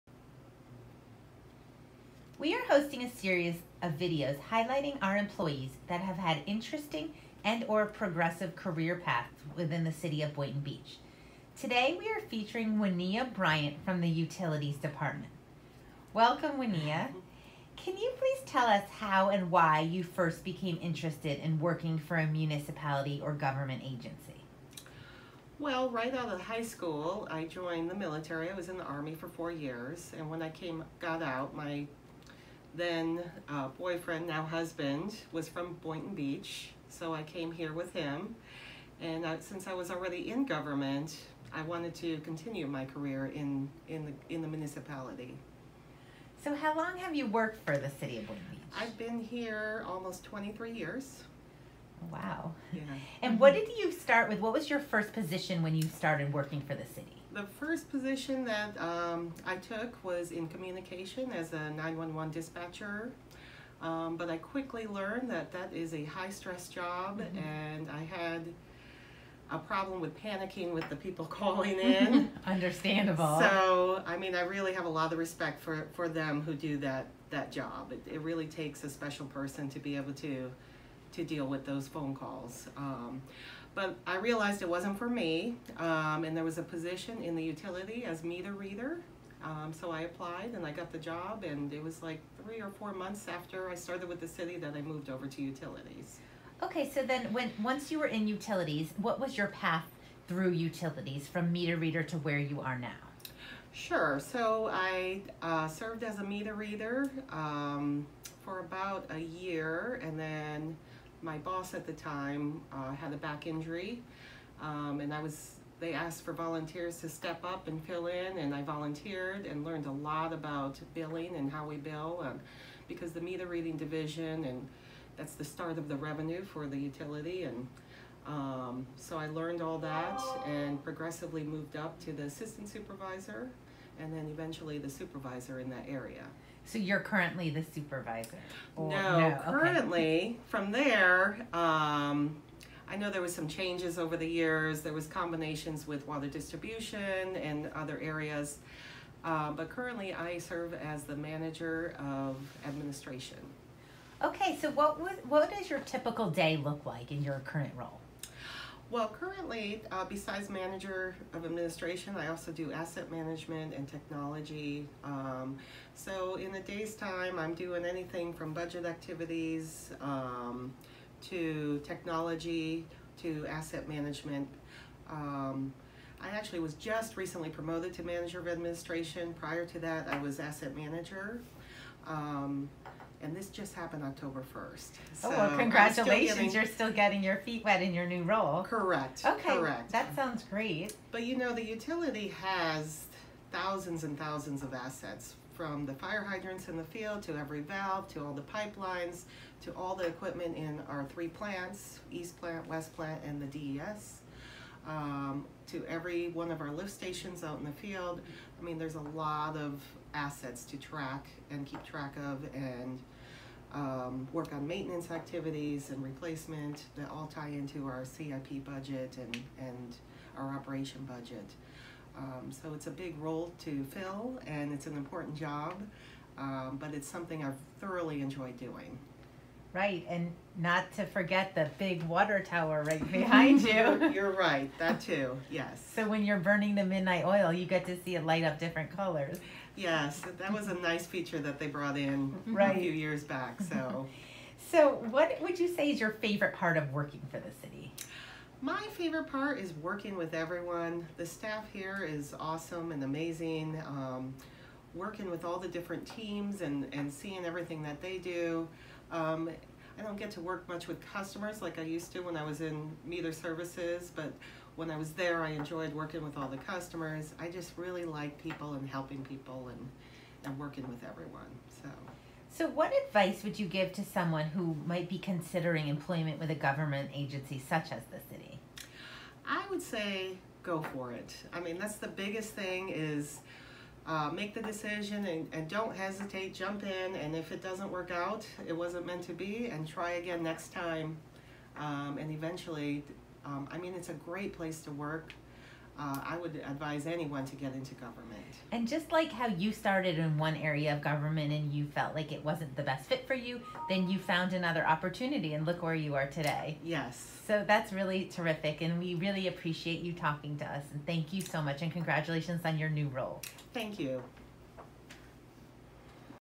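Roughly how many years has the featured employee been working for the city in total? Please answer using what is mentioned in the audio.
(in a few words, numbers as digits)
almost 23 years.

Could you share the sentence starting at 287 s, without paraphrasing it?
And if it doesn't work out, it wasn't meant to be, and try again next time.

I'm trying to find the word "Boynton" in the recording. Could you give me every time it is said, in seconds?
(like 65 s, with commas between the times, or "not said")
10 s, 35 s, 48 s.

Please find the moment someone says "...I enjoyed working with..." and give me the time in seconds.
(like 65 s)
265 s.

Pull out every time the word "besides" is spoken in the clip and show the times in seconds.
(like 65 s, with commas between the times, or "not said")
160 s.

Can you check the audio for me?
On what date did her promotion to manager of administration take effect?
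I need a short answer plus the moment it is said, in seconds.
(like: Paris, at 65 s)
October 1st, at 184 s.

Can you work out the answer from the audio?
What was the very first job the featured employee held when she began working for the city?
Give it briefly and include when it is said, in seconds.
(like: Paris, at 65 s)
911 dispatcher, at 61 s.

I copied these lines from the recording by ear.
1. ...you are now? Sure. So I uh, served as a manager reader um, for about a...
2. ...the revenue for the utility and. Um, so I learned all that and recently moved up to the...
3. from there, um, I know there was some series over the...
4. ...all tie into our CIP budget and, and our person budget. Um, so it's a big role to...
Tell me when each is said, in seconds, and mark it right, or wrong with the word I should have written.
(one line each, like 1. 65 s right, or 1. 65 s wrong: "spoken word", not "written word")
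1. 102 s wrong: "meter", not "manager"
2. 125 s wrong: "progressively", not "recently"
3. 140 s wrong: "changes", not "series"
4. 217 s wrong: "operation", not "person".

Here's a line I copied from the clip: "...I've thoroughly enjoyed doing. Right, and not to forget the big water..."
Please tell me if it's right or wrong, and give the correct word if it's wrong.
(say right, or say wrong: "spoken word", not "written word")
right.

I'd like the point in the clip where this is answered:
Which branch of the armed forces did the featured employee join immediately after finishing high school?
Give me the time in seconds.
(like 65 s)
28 s.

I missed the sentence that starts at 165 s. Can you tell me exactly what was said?
Um, so in a day's time, I'm doing anything from budget activities um, to technology to asset management.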